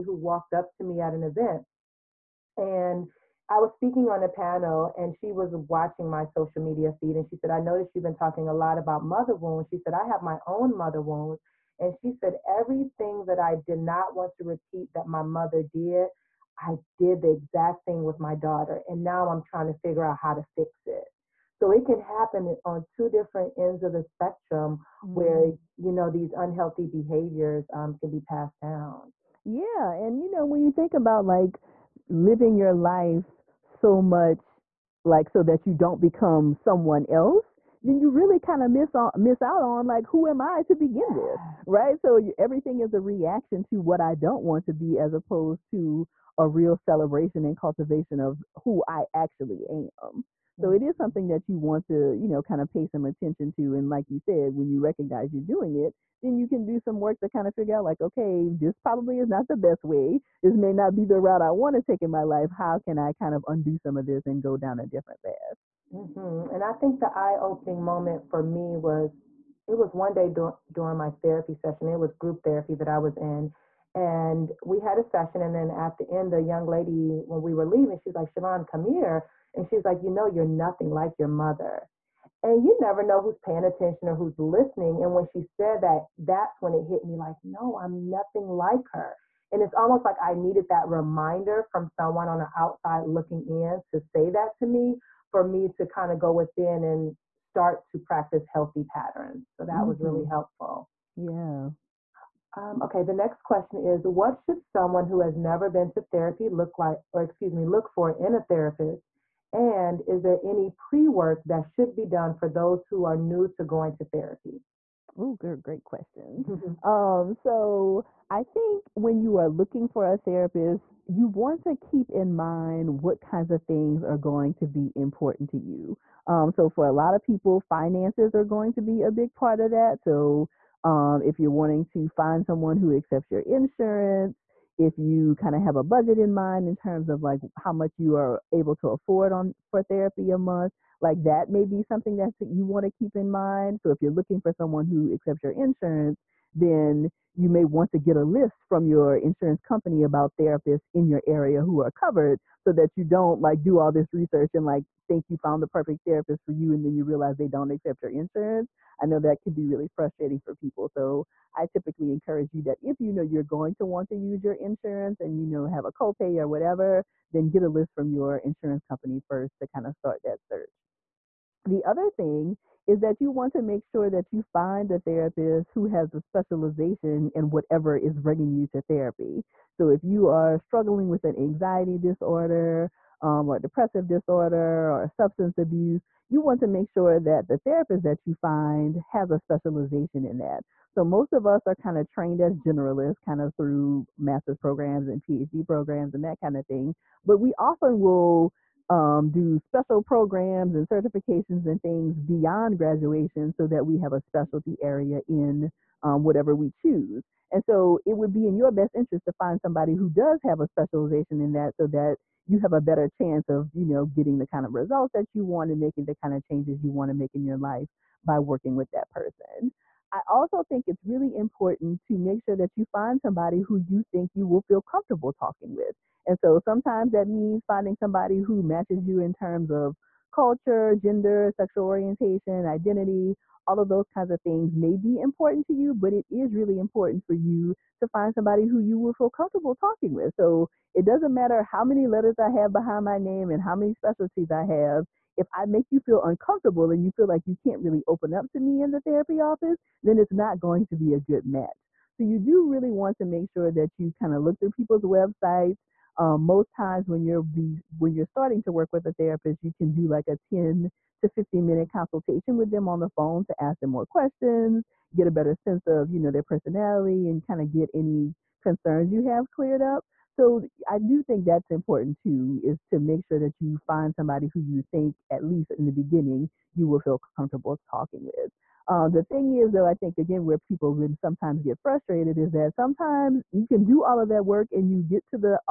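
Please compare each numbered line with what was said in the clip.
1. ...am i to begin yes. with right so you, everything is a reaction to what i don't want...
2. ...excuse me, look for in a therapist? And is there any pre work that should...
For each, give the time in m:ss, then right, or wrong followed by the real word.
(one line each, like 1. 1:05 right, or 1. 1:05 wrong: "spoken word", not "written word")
1. 0:40 right
2. 1:47 right.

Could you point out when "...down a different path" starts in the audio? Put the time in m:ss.
1:04.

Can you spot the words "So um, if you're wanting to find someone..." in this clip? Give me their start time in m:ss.
2:10.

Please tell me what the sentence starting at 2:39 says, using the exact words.
I know that can be really frustrating for people.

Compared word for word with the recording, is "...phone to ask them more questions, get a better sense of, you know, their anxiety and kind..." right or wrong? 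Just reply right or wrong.
wrong.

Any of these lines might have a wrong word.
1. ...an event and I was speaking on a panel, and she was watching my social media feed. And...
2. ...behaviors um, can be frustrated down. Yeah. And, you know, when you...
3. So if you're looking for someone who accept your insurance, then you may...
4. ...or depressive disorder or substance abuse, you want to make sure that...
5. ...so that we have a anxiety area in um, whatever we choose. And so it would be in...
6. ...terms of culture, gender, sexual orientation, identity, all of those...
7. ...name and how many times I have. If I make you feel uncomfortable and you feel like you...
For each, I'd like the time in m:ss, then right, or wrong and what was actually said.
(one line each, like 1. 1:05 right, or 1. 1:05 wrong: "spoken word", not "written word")
1. 0:01 right
2. 0:26 wrong: "passed", not "frustrated"
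3. 2:23 right
4. 3:03 right
5. 3:23 wrong: "specialty", not "anxiety"
6. 3:49 right
7. 4:03 wrong: "specialties", not "times".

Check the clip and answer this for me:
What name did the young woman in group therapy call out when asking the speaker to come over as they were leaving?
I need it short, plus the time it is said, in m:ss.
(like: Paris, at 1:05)
Siobhan, at 1:18.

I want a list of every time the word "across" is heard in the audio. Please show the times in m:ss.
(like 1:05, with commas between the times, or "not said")
not said.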